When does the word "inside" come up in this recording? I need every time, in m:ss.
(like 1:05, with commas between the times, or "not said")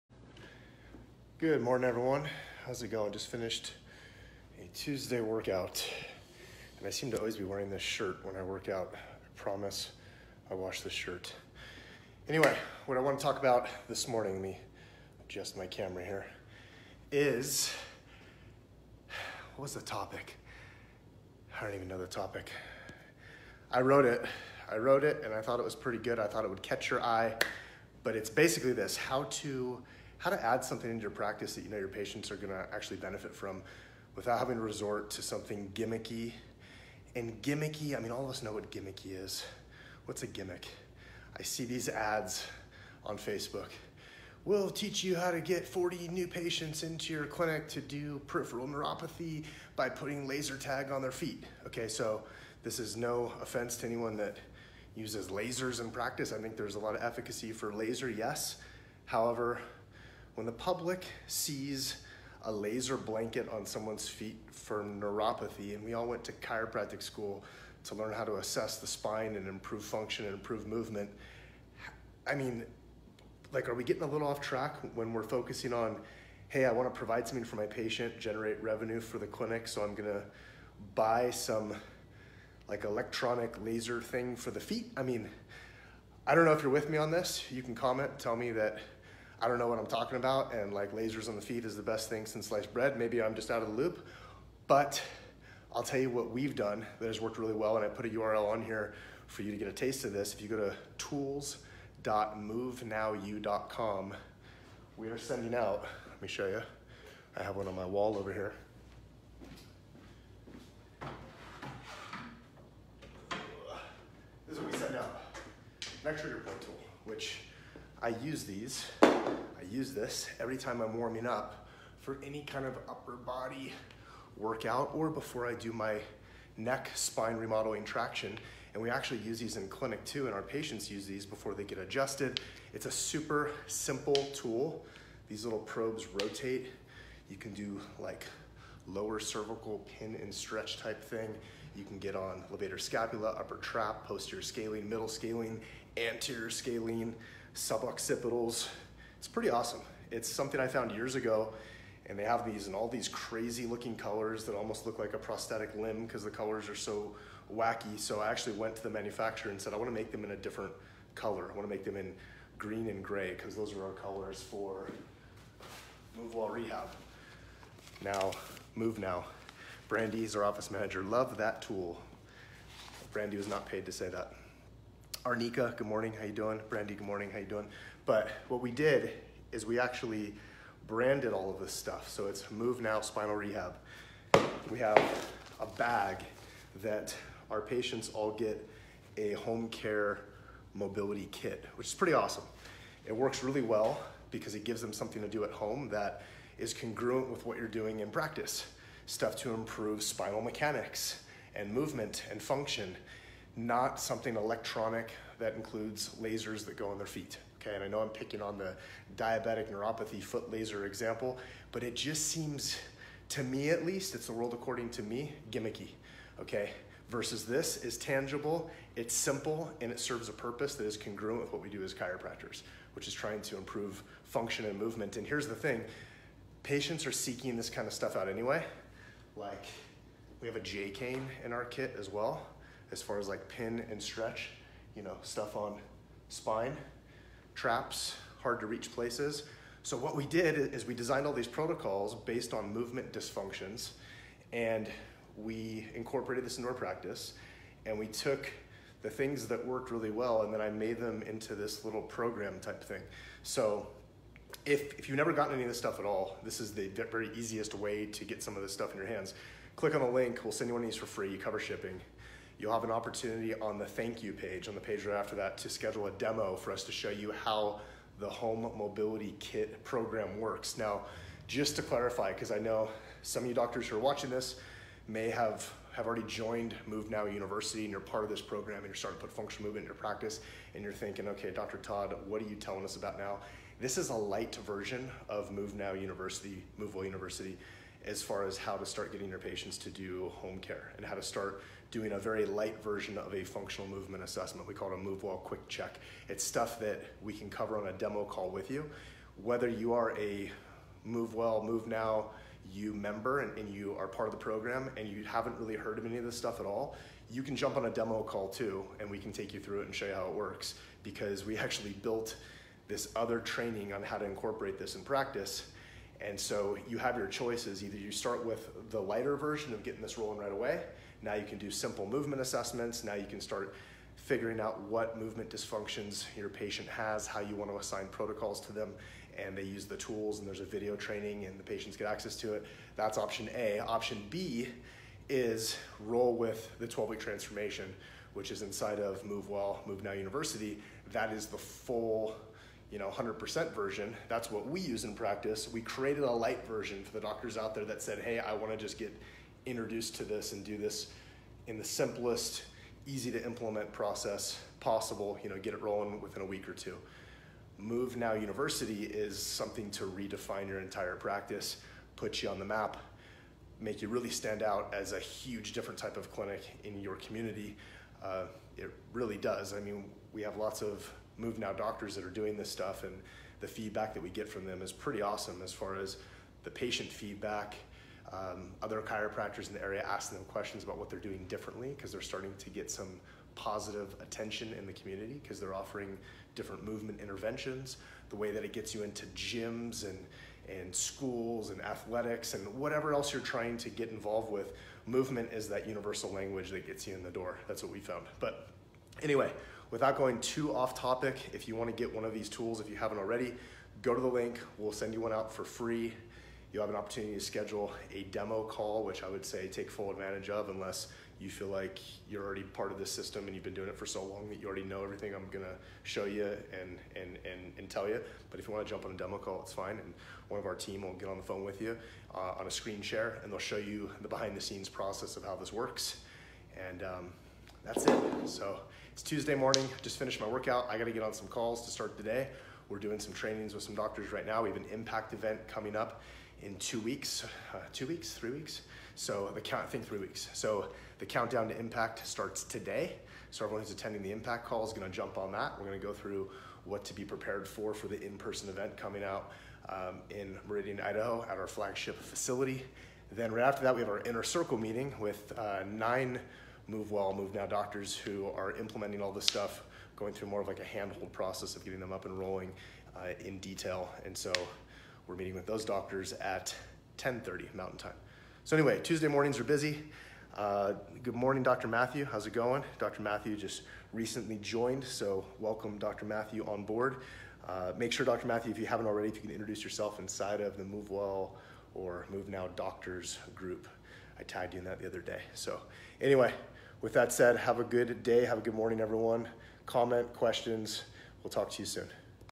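5:38, 8:00.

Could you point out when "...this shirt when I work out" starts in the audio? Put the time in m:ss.
0:07.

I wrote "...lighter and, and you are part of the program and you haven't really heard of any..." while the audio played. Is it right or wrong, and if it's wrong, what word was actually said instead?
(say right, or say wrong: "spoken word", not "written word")
wrong: "member", not "lighter".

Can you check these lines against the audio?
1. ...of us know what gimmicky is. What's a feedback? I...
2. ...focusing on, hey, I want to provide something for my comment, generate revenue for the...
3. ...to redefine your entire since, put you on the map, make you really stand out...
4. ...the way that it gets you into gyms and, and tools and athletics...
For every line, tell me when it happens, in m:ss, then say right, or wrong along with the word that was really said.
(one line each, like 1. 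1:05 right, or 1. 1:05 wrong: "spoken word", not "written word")
1. 0:38 wrong: "gimmick", not "feedback"
2. 1:15 wrong: "patient", not "comment"
3. 5:59 wrong: "practice", not "since"
4. 6:28 wrong: "schools", not "tools".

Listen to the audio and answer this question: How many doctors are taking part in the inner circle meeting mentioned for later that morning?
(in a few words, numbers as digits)
9.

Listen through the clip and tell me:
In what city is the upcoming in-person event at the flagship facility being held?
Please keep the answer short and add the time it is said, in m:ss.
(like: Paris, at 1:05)
Meridian, Idaho, at 7:30.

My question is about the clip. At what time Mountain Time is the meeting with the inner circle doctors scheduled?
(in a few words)
10:30.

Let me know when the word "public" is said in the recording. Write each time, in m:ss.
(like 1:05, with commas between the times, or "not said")
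1:00.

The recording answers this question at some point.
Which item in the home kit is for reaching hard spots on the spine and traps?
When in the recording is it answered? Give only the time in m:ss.
3:50.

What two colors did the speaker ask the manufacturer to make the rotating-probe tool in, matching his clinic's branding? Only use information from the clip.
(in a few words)
green and gray.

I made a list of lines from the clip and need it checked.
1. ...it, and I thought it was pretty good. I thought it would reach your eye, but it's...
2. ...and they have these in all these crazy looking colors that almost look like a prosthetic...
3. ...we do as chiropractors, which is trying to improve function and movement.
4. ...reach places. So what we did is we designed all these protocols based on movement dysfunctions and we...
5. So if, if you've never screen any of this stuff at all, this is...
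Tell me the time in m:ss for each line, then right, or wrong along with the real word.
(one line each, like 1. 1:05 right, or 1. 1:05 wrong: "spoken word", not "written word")
1. 0:25 wrong: "catch", not "reach"
2. 2:32 right
3. 3:41 right
4. 3:58 right
5. 4:13 wrong: "gotten", not "screen".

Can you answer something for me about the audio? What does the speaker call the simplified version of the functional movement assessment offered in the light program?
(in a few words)
move quick check.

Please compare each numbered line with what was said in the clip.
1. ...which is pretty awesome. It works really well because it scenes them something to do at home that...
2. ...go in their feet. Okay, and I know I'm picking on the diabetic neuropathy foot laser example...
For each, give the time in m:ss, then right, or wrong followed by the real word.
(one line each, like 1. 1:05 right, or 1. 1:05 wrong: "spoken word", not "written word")
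1. 3:11 wrong: "gives", not "scenes"
2. 3:26 right.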